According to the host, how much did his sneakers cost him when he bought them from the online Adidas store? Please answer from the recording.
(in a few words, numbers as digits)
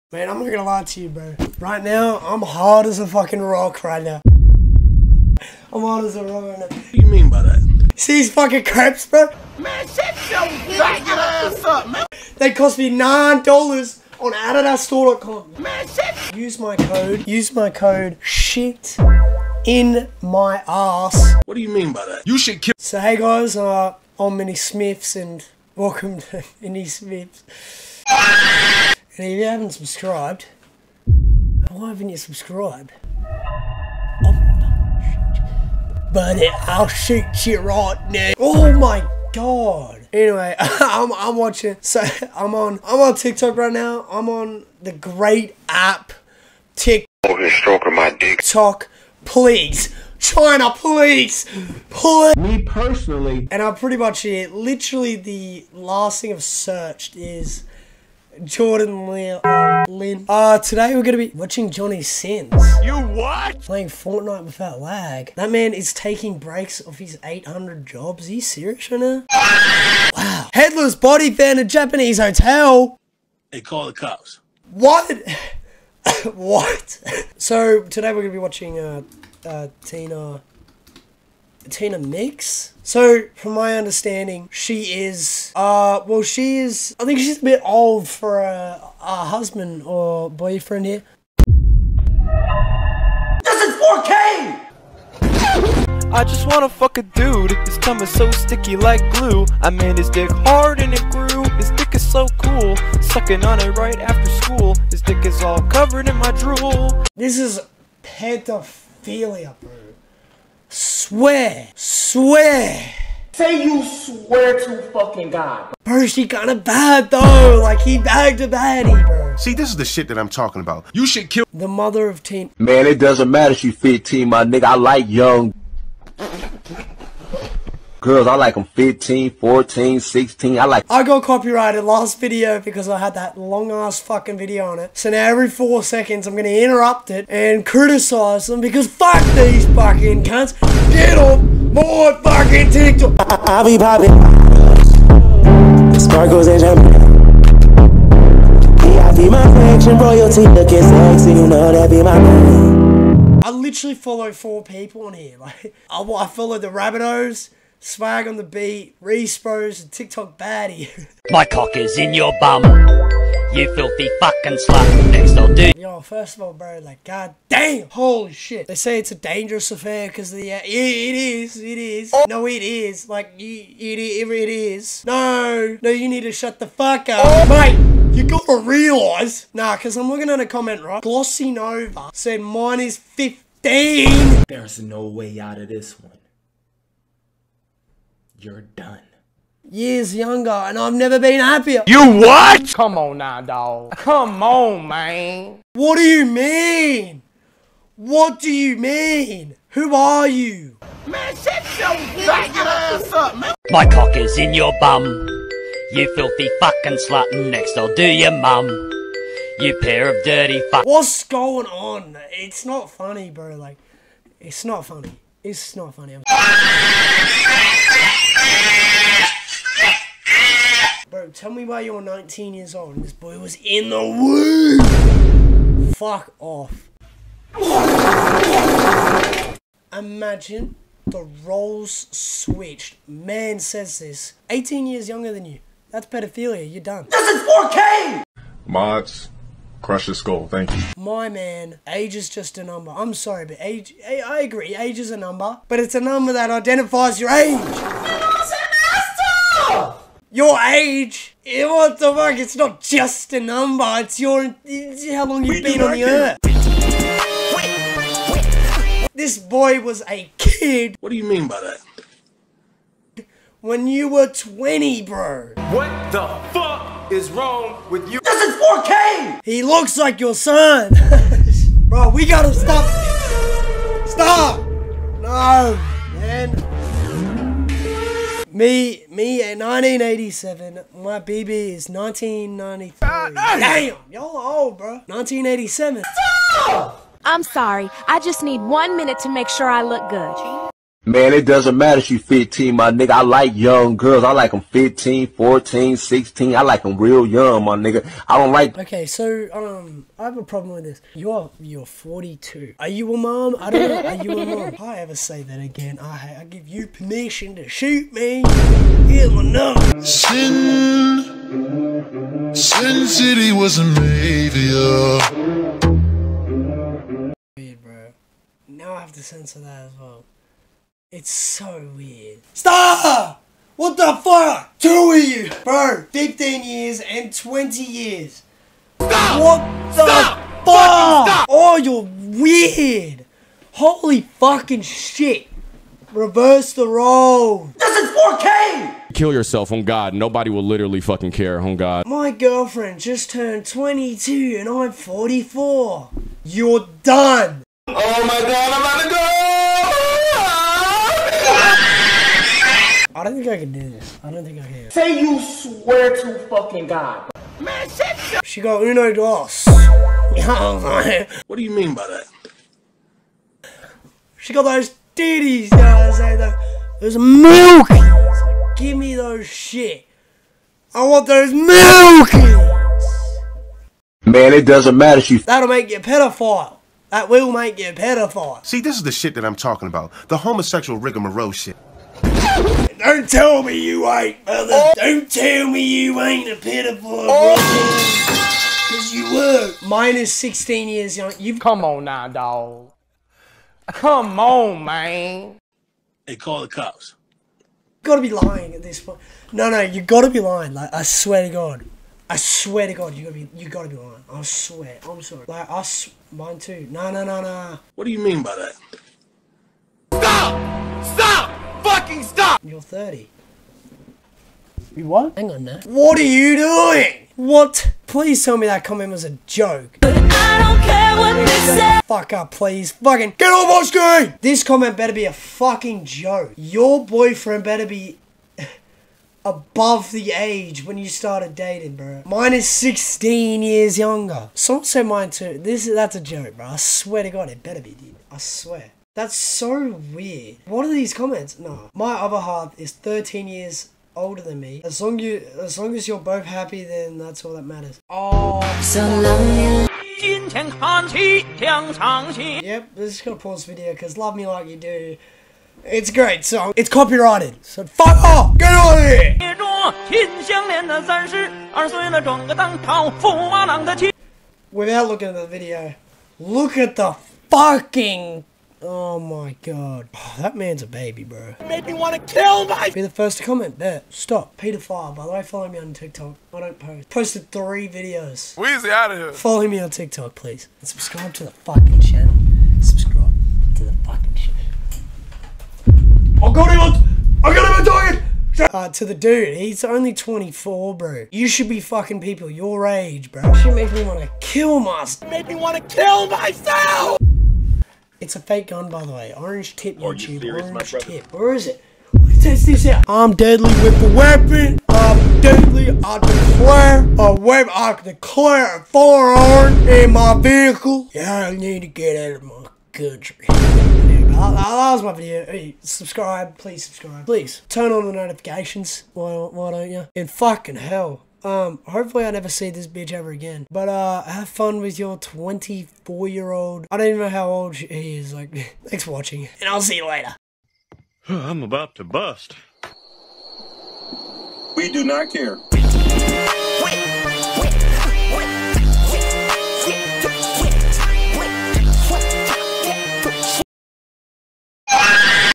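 $9.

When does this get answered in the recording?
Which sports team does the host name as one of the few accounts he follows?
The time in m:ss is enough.
2:36.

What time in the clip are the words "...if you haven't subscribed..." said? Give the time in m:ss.
0:29.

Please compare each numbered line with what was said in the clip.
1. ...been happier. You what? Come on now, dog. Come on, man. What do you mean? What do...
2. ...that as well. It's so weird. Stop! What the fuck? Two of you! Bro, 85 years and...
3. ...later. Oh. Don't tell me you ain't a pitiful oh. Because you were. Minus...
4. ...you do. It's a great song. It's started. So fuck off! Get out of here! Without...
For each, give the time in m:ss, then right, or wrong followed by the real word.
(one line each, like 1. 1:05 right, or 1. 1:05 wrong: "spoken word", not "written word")
1. 3:11 right
2. 5:19 wrong: "15", not "85"
3. 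6:24 wrong: "brother", not "later"
4. 7:34 wrong: "copyrighted", not "started".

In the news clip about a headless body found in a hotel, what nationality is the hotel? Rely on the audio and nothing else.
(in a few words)
Japanese.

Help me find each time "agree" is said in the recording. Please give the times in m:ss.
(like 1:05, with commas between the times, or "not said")
4:04.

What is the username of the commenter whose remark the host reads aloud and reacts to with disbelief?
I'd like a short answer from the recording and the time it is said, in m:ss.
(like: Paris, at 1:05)
Glossy Nova, at 3:01.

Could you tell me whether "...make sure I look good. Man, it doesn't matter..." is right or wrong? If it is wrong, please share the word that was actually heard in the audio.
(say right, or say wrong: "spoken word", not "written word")
right.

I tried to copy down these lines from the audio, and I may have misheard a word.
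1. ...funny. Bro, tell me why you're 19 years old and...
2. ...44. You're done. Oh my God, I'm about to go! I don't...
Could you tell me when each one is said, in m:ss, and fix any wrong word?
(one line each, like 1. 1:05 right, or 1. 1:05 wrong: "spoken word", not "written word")
1. 3:35 right
2. 5:44 right.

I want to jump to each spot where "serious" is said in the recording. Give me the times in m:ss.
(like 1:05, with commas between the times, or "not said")
1:08, 8:20.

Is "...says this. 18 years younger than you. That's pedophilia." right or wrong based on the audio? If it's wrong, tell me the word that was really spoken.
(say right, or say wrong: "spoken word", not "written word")
right.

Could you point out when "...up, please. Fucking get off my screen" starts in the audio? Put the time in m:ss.
7:02.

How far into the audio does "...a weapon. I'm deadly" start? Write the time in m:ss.
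8:24.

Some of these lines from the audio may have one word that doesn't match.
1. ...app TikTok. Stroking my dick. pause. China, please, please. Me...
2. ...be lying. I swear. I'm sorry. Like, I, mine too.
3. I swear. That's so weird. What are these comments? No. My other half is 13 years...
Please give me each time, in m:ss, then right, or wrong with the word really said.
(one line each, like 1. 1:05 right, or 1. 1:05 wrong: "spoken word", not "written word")
1. 0:45 wrong: "please", not "pause"
2. 6:43 right
3. 7:18 right.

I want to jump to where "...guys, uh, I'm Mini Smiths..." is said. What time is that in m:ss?
0:23.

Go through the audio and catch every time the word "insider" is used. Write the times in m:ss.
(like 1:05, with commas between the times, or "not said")
not said.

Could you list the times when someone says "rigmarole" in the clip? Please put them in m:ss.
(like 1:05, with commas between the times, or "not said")
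6:20.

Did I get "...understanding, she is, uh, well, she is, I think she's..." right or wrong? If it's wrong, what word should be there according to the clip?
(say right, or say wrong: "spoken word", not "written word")
right.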